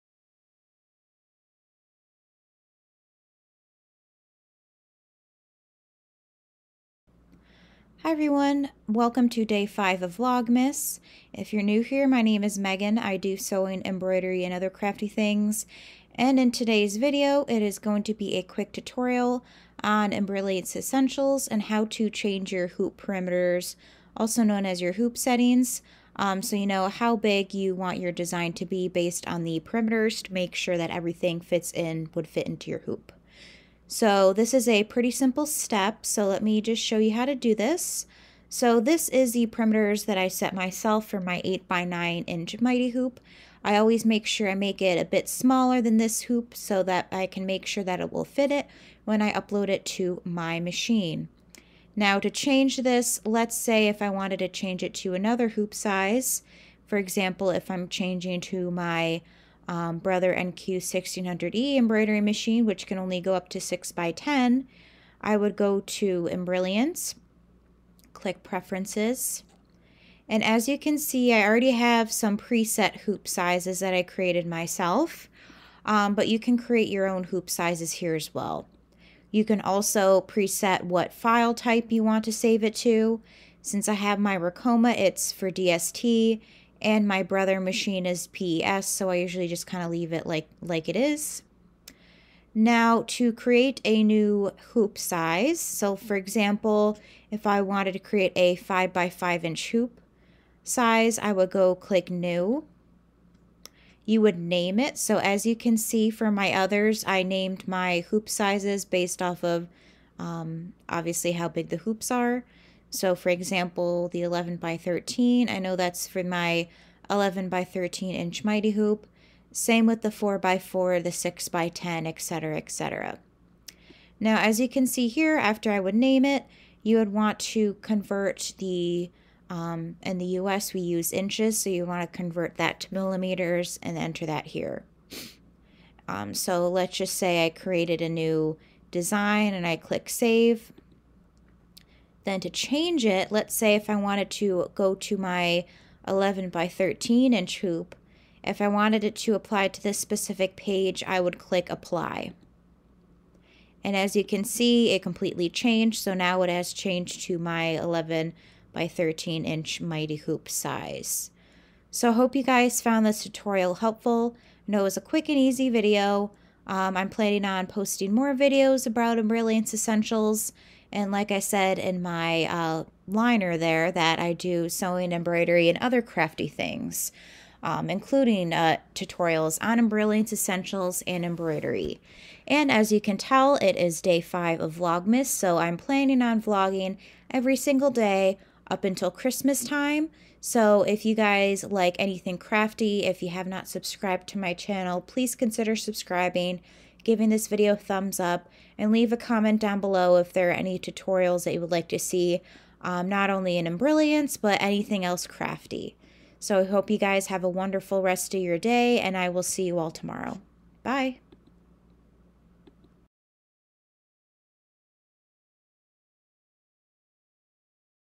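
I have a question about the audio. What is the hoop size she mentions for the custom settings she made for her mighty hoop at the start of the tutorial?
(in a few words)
8 by 9 inch.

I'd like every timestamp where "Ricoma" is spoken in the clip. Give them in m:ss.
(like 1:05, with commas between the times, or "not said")
1:24.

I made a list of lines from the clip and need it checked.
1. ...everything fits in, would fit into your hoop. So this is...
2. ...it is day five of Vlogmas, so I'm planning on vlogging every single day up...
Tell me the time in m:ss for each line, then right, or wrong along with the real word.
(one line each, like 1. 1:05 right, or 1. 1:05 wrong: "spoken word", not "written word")
1. 0:30 right
2. 3:03 right.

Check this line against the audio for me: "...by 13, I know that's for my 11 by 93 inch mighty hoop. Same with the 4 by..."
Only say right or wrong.
wrong.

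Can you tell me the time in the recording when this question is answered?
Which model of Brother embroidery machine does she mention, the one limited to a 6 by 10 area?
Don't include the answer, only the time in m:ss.
1:00.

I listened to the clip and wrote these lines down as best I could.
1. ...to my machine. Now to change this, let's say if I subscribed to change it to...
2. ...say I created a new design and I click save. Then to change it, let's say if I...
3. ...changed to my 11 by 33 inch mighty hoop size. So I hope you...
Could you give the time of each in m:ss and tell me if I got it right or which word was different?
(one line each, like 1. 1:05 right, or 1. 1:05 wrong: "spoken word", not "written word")
1. 0:49 wrong: "wanted", not "subscribed"
2. 2:17 right
3. 2:36 wrong: "13", not "33".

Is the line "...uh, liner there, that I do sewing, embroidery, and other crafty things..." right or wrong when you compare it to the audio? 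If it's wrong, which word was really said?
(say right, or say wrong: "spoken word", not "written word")
right.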